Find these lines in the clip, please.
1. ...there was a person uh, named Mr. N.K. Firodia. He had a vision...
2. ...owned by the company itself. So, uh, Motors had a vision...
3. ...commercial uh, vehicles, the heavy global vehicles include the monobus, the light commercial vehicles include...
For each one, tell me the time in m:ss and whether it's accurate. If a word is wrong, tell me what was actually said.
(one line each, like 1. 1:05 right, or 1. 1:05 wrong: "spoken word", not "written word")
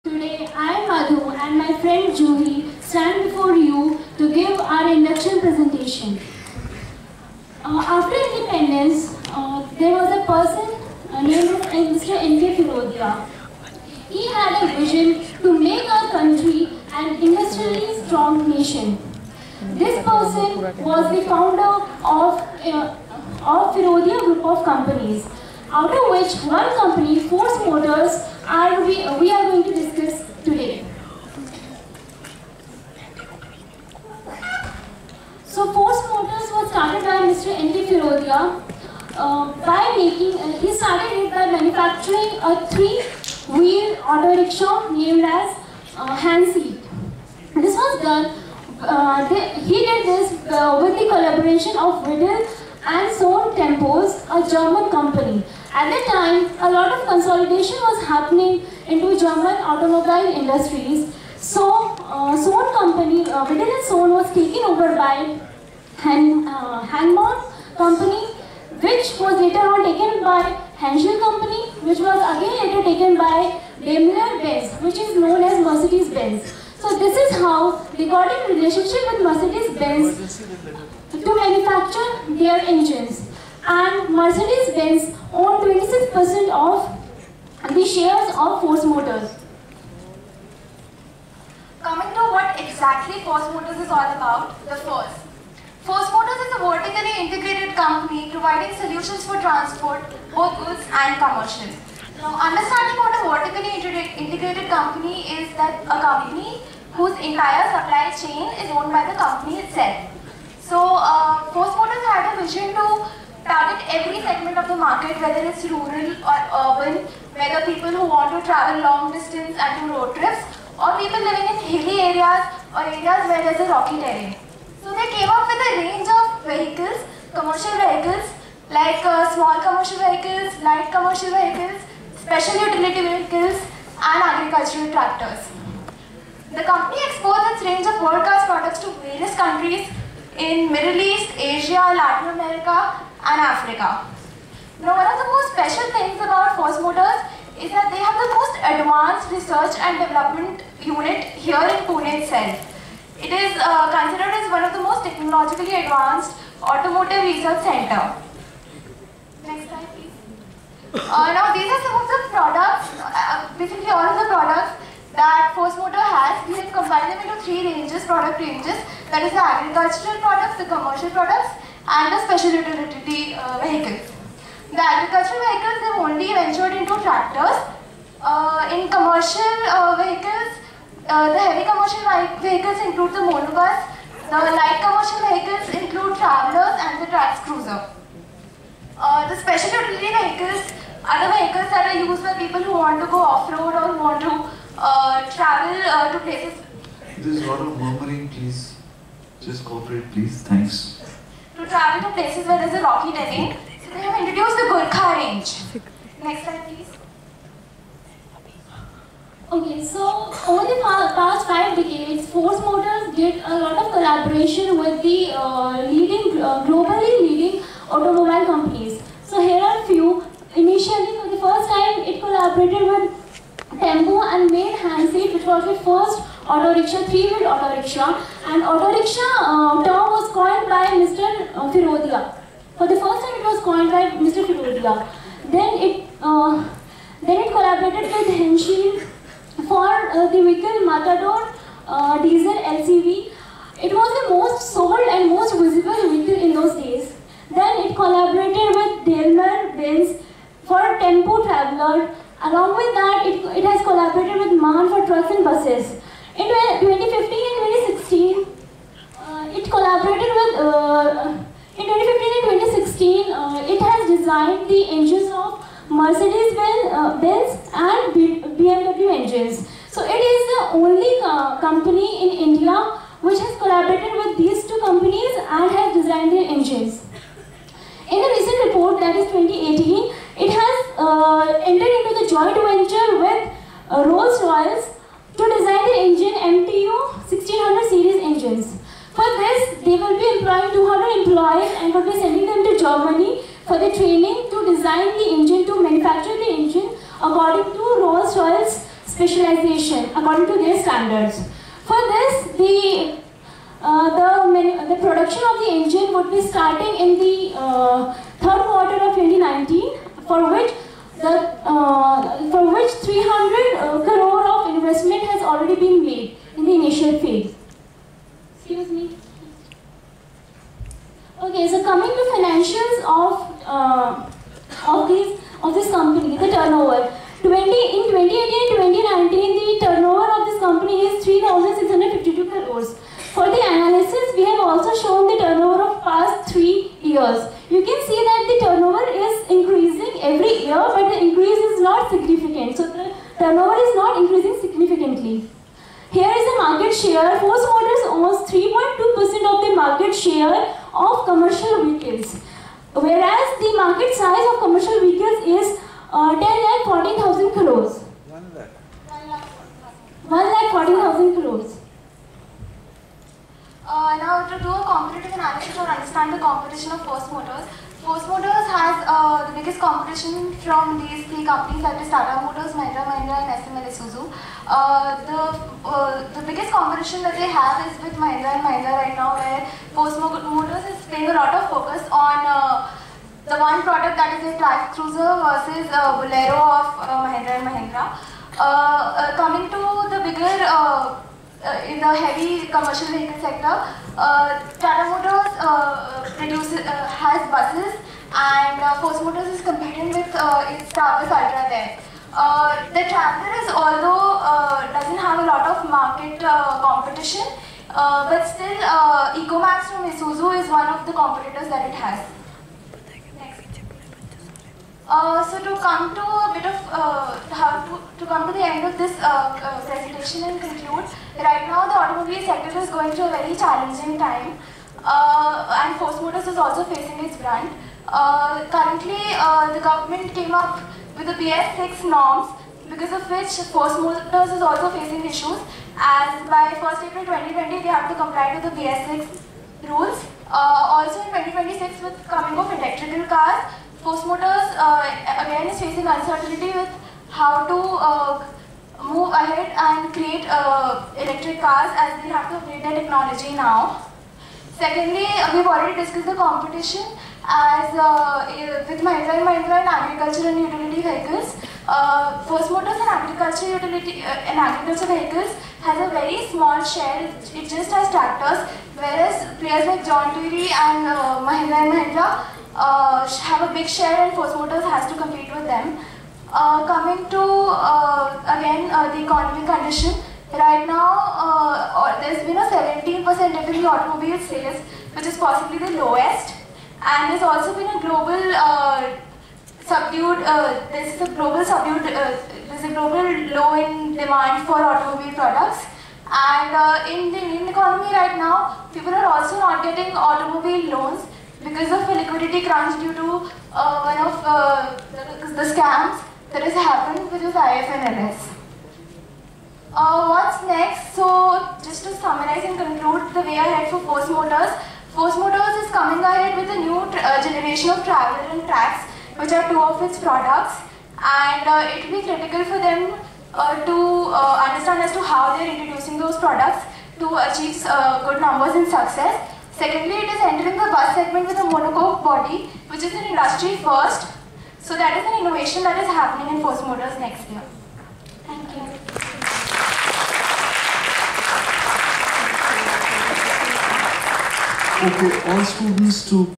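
1. 0:09 right
2. 1:48 right
3. 2:58 wrong: "commercial", not "global".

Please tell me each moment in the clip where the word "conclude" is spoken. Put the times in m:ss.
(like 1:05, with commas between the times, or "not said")
7:00, 8:32.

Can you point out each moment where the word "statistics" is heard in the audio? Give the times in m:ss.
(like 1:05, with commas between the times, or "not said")
not said.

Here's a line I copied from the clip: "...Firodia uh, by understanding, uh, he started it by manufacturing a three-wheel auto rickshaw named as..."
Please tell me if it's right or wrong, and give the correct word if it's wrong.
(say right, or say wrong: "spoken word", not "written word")
wrong: "making", not "understanding".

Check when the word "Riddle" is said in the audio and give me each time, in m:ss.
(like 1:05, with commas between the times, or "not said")
0:52, 1:03.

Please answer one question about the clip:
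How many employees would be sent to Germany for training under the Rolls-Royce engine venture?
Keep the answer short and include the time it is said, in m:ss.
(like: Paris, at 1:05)
200, at 4:50.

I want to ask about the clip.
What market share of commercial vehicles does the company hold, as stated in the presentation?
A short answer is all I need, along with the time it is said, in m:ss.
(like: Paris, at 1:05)
3.2%, at 5:48.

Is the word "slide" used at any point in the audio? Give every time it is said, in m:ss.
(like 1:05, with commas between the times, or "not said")
2:39, 3:26.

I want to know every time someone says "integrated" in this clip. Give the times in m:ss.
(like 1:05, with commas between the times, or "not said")
1:37, 1:43.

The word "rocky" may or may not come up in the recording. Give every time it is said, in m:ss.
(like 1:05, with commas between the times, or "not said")
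2:03, 3:22.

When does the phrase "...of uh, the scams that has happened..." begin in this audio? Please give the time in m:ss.
8:24.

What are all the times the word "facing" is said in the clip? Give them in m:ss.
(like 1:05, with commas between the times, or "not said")
7:06, 7:14, 7:25.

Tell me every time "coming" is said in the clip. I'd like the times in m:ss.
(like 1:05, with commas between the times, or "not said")
1:31, 6:29, 7:22, 7:56, 8:35.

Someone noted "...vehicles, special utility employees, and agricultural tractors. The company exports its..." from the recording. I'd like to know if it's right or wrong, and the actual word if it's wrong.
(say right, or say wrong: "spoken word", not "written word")
wrong: "vehicles", not "employees".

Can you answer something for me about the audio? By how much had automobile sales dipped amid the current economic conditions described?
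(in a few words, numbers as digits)
17%.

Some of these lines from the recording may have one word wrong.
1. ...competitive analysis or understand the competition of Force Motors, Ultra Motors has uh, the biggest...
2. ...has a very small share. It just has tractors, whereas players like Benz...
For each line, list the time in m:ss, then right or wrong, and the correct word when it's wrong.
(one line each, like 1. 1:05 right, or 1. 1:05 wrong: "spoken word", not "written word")
1. 6:04 wrong: "Force", not "Ultra"
2. 7:45 wrong: "John", not "Benz".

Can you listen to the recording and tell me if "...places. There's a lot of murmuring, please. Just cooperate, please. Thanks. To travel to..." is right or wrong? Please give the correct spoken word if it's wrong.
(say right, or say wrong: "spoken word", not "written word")
right.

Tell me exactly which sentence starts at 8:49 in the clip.
Secondly, it is entering the bus segment with a monocoque body, which is an industry first.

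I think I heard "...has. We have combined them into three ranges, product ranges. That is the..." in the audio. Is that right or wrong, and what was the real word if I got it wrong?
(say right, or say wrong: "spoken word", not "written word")
right.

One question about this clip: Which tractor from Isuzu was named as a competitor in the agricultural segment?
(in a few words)
EcoMax.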